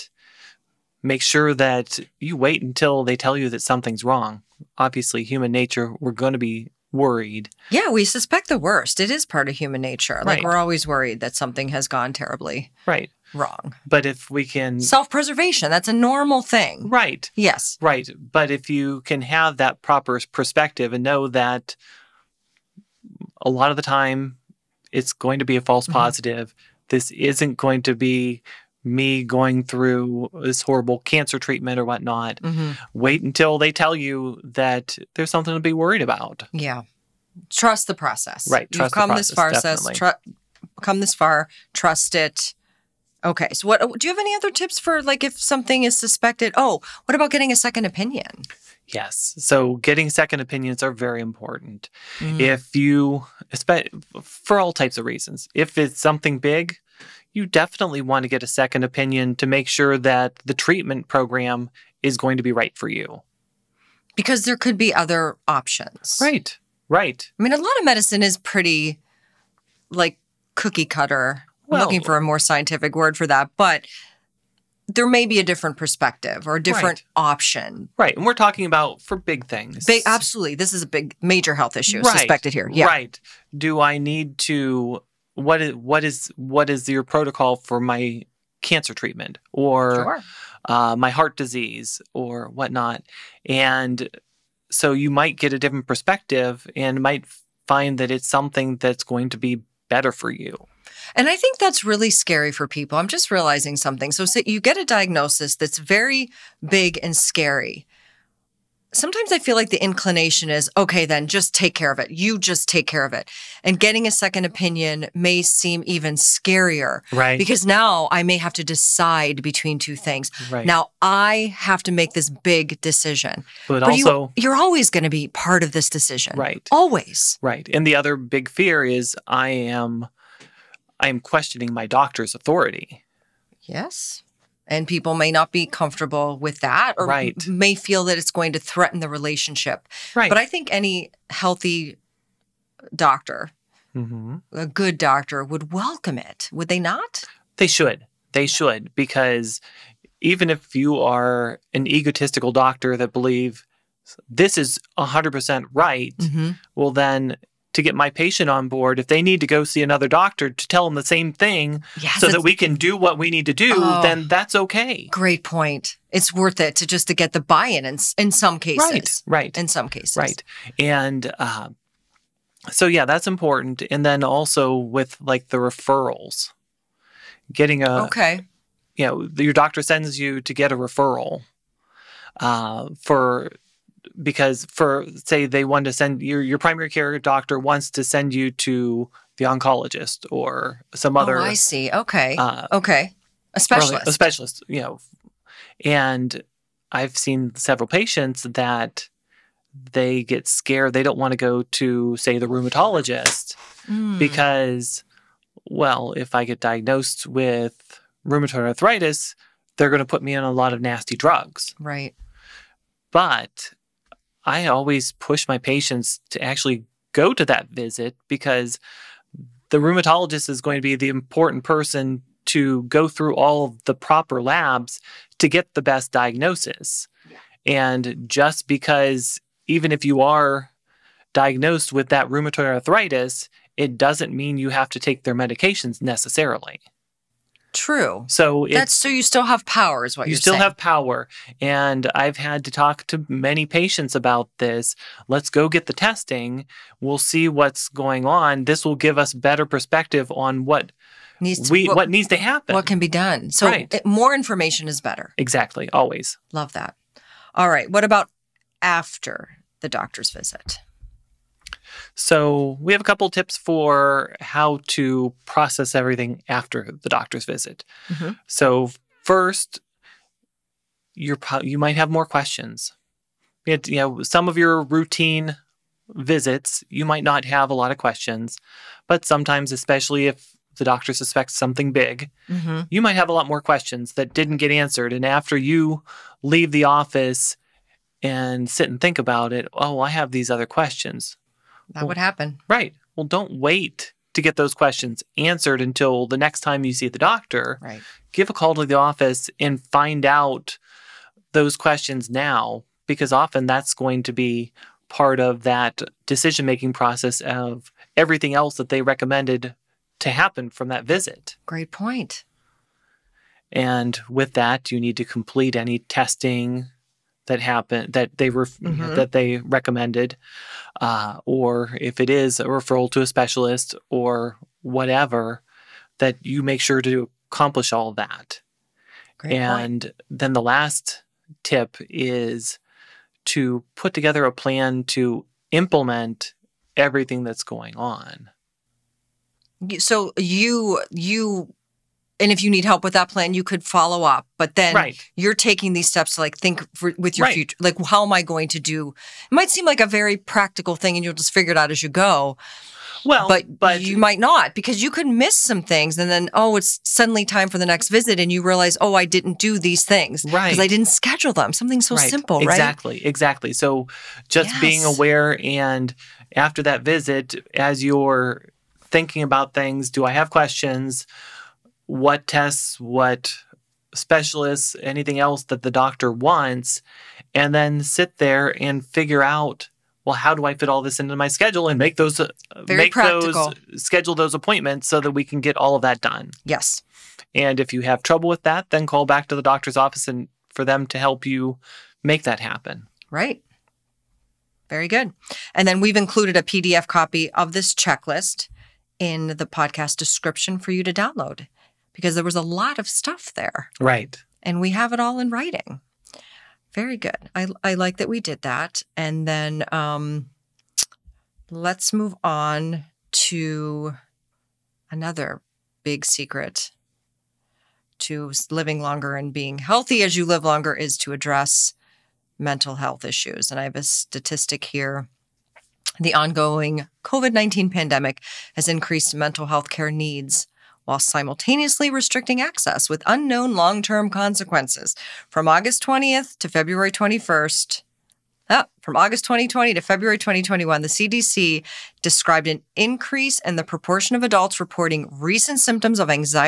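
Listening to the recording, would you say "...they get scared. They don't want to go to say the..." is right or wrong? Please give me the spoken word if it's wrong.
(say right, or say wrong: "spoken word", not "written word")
right.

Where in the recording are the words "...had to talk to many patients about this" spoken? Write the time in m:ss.
4:02.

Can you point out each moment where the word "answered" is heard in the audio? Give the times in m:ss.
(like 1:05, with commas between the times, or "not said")
4:44, 4:55.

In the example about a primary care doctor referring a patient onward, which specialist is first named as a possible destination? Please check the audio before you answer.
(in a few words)
oncologist.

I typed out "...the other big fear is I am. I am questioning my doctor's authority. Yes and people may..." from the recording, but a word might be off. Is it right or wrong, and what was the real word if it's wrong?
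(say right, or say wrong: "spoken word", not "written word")
right.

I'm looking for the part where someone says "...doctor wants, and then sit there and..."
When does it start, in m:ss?
6:15.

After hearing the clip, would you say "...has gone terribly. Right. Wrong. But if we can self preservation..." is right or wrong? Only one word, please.
right.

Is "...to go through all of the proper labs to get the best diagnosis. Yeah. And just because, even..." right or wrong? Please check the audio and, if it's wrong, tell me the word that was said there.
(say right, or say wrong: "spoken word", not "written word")
right.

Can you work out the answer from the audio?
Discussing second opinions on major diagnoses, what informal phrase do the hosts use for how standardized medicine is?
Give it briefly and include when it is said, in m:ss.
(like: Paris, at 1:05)
cookie cutter, at 1:10.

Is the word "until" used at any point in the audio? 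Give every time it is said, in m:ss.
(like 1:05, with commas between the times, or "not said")
0:02, 0:33, 4:55.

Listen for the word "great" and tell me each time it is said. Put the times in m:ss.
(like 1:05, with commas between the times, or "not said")
2:45, 5:11, 5:29.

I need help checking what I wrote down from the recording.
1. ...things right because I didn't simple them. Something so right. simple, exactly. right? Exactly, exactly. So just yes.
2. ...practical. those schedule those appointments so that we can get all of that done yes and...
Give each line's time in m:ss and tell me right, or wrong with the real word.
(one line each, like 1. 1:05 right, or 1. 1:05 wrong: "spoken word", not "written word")
1. 6:00 wrong: "schedule", not "simple"
2. 6:23 right.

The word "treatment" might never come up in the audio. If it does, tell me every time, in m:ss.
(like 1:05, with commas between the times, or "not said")
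0:31, 1:00, 1:28.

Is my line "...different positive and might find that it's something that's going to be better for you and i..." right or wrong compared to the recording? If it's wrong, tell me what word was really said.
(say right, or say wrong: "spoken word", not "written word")
wrong: "perspective", not "positive".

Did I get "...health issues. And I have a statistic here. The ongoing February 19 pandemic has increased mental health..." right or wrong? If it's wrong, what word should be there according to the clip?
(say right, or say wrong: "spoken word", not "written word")
wrong: "COVID", not "February".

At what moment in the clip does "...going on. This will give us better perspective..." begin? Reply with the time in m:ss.
4:07.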